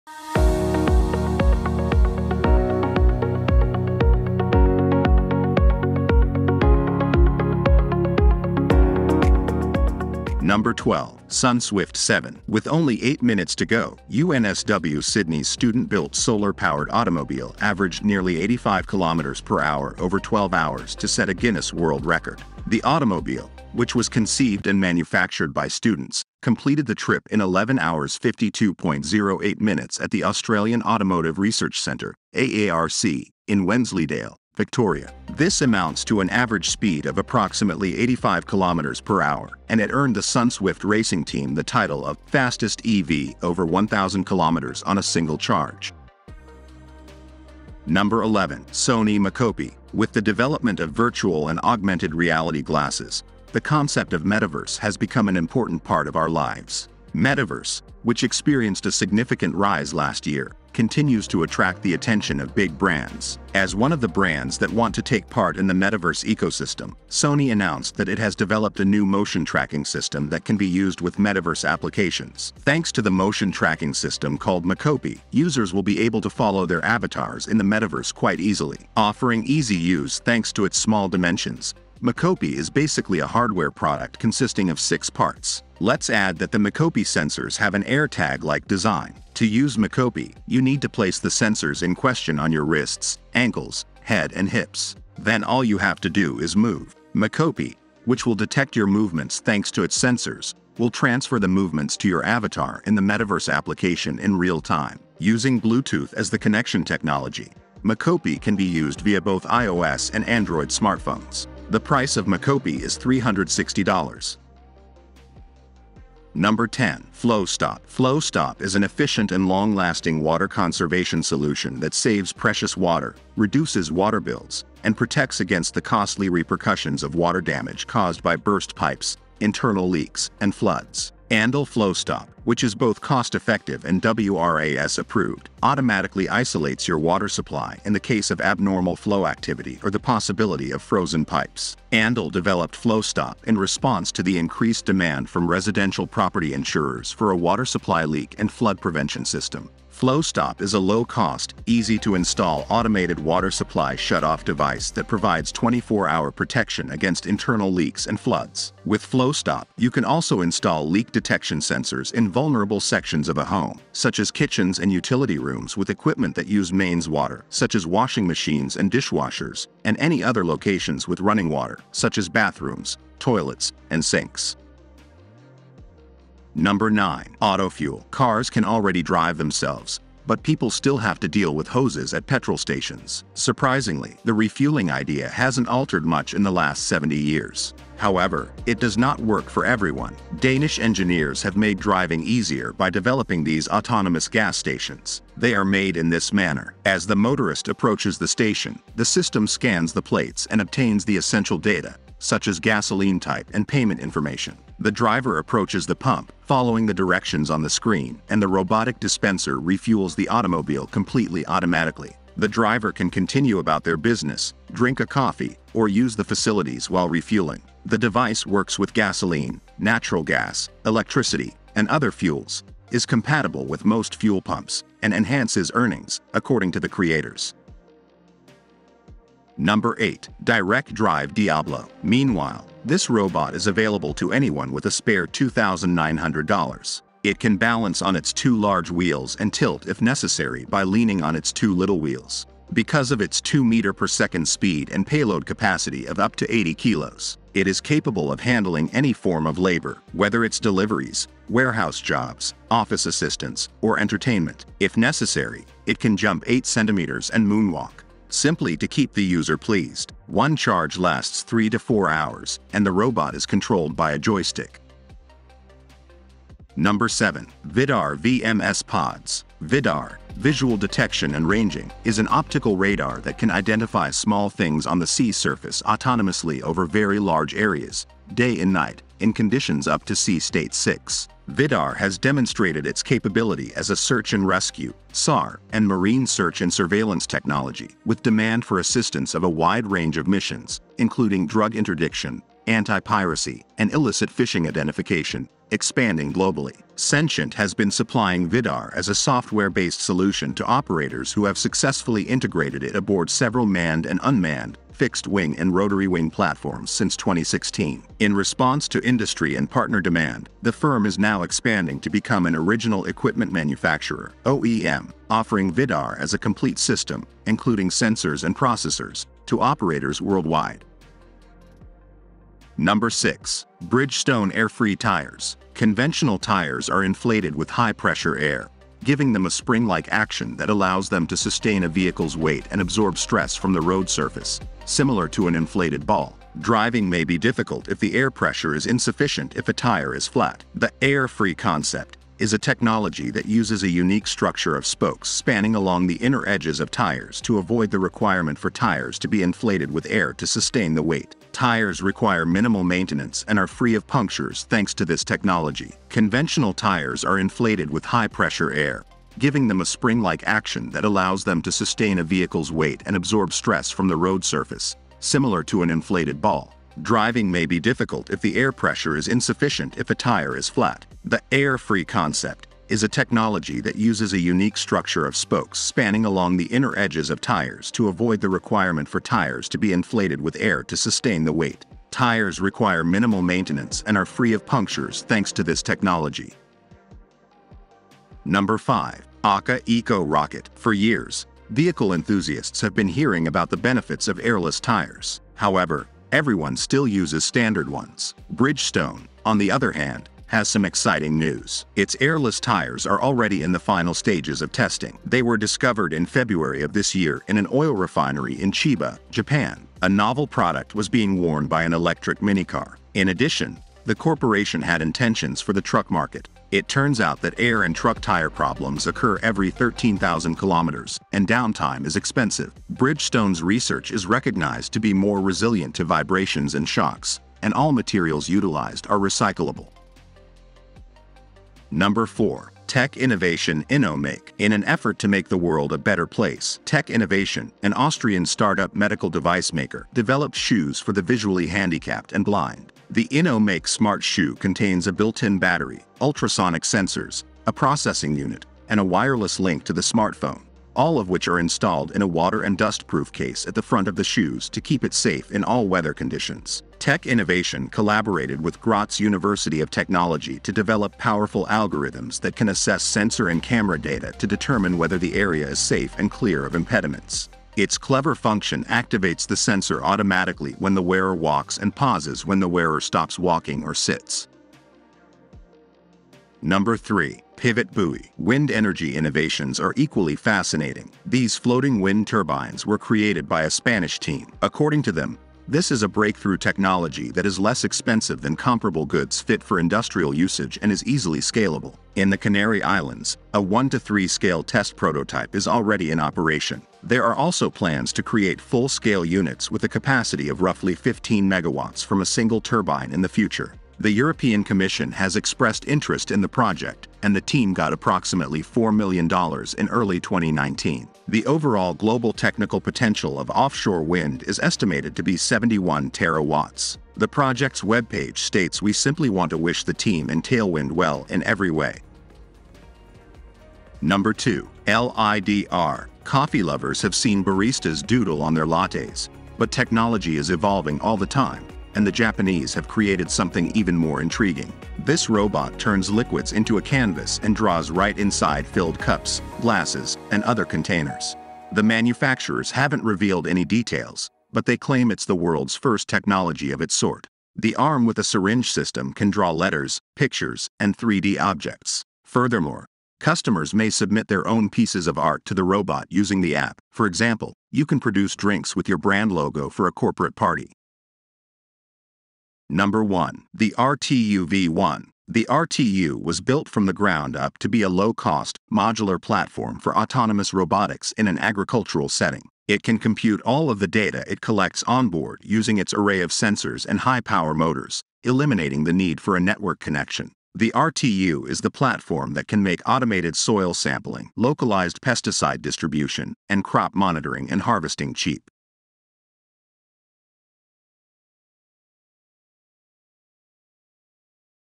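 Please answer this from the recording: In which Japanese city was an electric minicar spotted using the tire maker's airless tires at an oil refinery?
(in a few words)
Chiba.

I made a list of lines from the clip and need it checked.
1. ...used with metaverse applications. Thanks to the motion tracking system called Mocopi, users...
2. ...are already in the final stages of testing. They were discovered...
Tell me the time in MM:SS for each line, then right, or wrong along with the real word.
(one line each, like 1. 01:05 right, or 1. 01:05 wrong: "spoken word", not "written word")
1. 01:10 right
2. 06:43 right.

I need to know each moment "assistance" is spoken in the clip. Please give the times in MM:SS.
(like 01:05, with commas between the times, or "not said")
04:13, 04:48.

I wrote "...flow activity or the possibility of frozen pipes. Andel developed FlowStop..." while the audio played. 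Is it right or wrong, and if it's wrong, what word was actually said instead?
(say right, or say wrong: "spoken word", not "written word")
right.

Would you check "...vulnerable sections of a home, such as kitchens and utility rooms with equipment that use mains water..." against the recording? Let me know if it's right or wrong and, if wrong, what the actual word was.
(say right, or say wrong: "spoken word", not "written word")
right.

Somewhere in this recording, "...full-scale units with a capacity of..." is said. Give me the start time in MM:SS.
08:18.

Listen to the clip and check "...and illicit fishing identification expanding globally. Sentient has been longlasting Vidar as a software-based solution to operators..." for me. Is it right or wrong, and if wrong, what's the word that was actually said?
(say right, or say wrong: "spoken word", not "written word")
wrong: "supplying", not "longlasting".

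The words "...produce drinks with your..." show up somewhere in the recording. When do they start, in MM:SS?
09:17.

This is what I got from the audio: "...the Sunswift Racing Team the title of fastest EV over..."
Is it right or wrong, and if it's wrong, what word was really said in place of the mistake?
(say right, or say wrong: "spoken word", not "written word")
right.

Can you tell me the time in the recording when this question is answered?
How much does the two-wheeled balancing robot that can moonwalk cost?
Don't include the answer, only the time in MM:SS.
03:55.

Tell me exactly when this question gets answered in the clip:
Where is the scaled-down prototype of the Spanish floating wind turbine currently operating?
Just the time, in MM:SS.
08:12.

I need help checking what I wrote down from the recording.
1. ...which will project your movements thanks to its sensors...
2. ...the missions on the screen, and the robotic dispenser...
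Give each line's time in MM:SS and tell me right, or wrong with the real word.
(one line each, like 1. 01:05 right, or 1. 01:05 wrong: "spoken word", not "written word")
1. 01:38 wrong: "detect", not "project"
2. 03:26 wrong: "directions", not "missions".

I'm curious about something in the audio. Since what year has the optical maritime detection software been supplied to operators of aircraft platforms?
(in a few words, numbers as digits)
2016.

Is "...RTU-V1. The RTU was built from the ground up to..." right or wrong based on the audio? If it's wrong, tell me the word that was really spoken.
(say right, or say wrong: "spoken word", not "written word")
right.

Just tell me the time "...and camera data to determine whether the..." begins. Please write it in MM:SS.
07:43.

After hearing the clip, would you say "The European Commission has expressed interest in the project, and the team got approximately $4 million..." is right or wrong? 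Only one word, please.
right.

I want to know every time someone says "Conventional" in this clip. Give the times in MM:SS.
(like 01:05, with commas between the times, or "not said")
05:25, 05:56.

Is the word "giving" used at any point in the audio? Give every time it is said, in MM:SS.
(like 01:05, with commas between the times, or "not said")
05:29, 05:59.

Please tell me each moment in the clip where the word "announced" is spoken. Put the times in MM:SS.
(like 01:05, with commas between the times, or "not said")
01:07.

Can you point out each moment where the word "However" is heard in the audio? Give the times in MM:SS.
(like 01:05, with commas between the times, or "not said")
03:07, 06:35.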